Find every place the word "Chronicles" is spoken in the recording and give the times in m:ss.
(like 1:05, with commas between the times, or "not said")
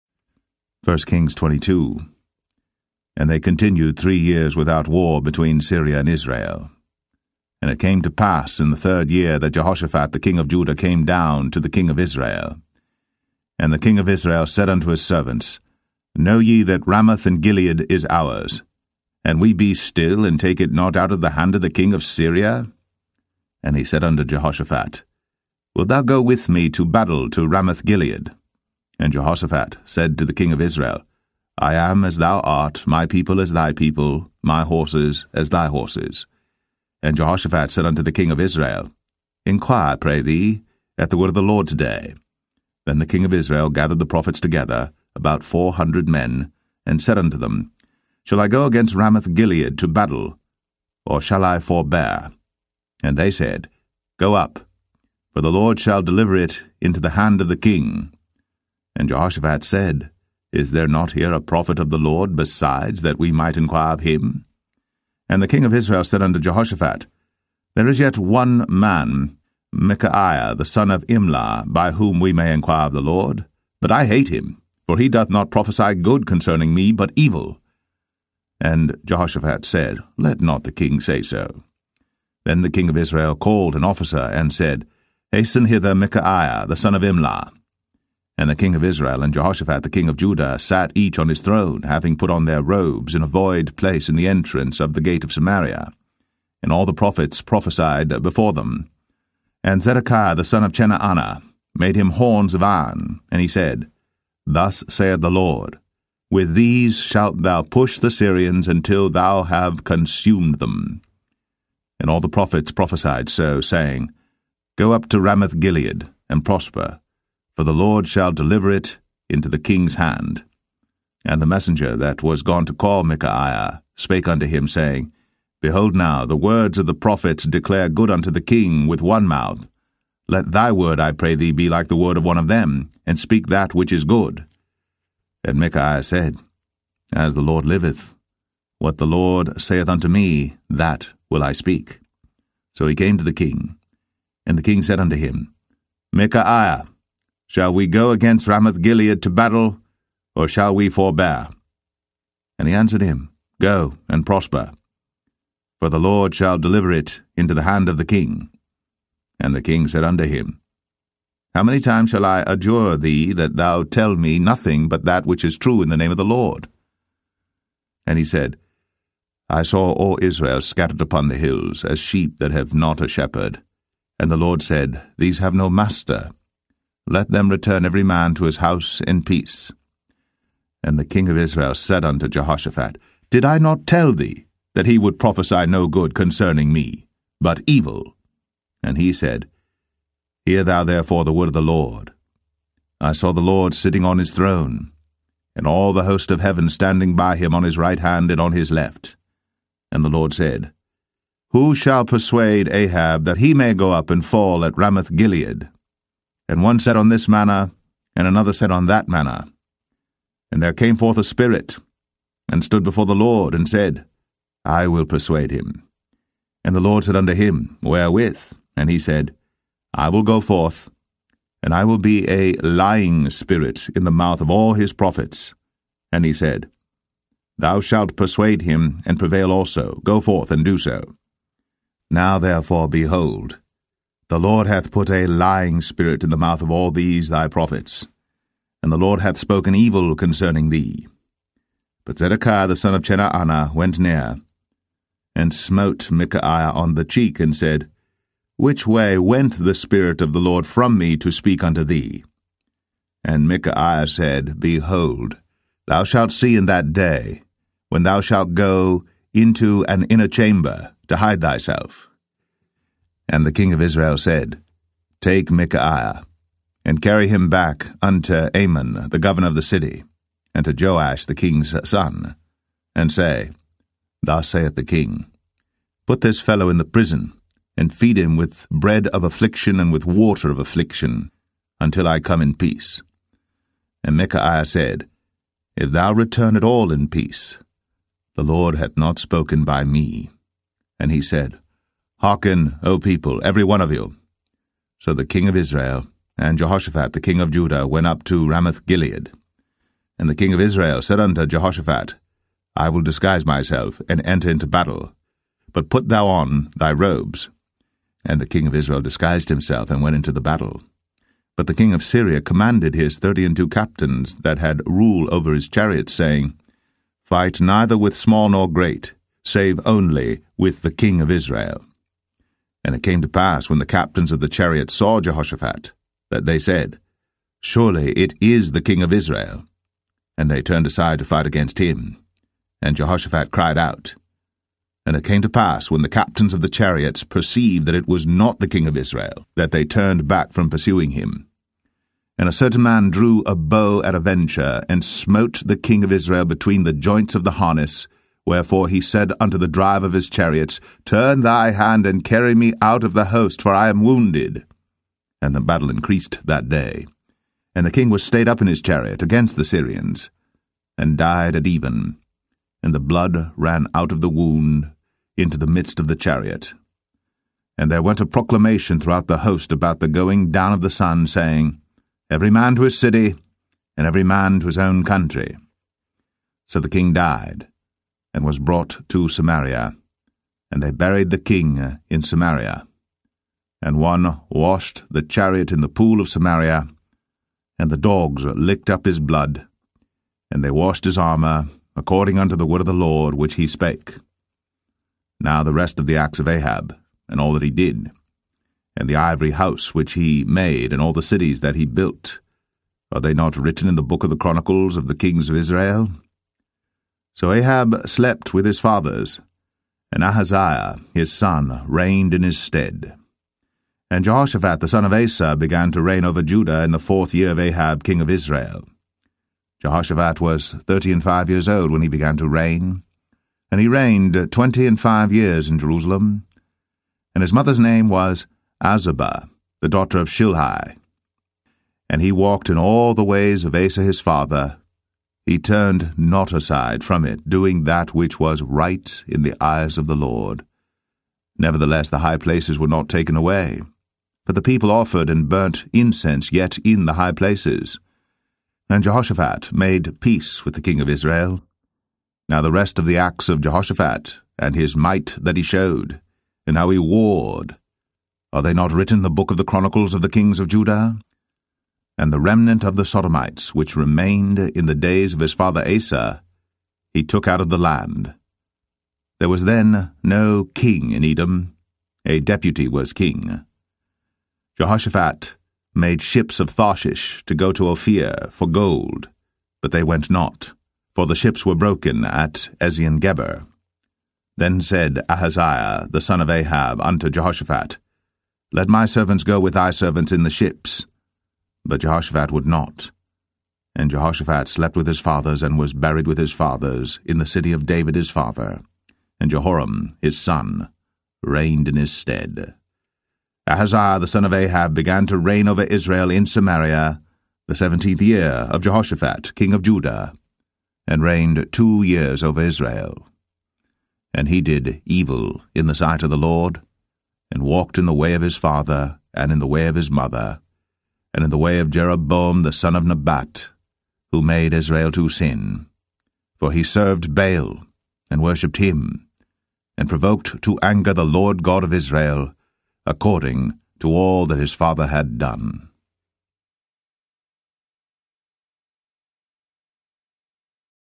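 6:44, 7:39.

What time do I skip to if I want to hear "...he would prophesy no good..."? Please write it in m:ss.
3:04.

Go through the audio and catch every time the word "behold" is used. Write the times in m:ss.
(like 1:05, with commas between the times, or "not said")
2:05, 3:52, 4:14.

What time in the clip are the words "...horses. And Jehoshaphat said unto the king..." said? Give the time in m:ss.
0:35.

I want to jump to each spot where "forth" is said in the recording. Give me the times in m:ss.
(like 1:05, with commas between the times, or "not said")
3:30, 3:40, 3:50.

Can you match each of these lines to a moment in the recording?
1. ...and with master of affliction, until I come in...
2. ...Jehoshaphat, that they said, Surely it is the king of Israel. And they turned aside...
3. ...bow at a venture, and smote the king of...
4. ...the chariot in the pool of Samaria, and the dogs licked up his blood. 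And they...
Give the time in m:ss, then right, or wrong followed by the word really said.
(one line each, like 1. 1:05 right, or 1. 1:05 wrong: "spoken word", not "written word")
1. 4:39 wrong: "water", not "master"
2. 5:25 right
3. 5:43 right
4. 6:25 right.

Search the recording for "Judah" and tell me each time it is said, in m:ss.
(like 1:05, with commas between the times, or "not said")
0:10, 1:30, 4:57, 6:56, 7:40, 8:29.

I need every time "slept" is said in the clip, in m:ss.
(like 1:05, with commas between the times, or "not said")
6:48, 8:14.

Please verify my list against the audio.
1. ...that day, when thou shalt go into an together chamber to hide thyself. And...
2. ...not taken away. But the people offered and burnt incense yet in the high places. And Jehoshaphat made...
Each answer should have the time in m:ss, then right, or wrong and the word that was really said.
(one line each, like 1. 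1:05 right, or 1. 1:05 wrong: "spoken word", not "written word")
1. 4:16 wrong: "inner", not "together"
2. 7:22 right.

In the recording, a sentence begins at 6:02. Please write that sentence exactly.
And the blood ran out of the wound into the midst of the chariot.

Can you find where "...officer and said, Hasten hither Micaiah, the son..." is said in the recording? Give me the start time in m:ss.
1:23.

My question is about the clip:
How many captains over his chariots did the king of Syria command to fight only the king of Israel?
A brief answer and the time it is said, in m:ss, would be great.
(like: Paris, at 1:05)
32, at 5:13.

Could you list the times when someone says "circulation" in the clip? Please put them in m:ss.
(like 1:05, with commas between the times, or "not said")
not said.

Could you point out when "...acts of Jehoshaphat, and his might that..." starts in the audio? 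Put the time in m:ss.
7:33.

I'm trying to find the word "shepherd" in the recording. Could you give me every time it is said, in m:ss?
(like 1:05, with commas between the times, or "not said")
2:53.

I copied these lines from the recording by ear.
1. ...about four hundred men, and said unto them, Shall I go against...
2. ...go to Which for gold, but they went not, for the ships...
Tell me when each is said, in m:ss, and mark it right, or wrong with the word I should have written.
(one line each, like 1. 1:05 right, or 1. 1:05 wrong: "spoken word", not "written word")
1. 0:45 right
2. 7:57 wrong: "Ophir", not "Which".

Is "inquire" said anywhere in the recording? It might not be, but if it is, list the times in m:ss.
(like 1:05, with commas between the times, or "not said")
0:39, 1:03, 1:12.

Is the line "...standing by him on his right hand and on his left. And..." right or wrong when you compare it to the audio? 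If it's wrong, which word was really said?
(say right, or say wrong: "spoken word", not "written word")
right.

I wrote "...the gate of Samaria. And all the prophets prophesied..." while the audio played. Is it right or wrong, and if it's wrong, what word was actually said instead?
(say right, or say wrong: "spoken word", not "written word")
right.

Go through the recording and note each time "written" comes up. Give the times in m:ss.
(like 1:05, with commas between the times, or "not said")
6:43, 7:38.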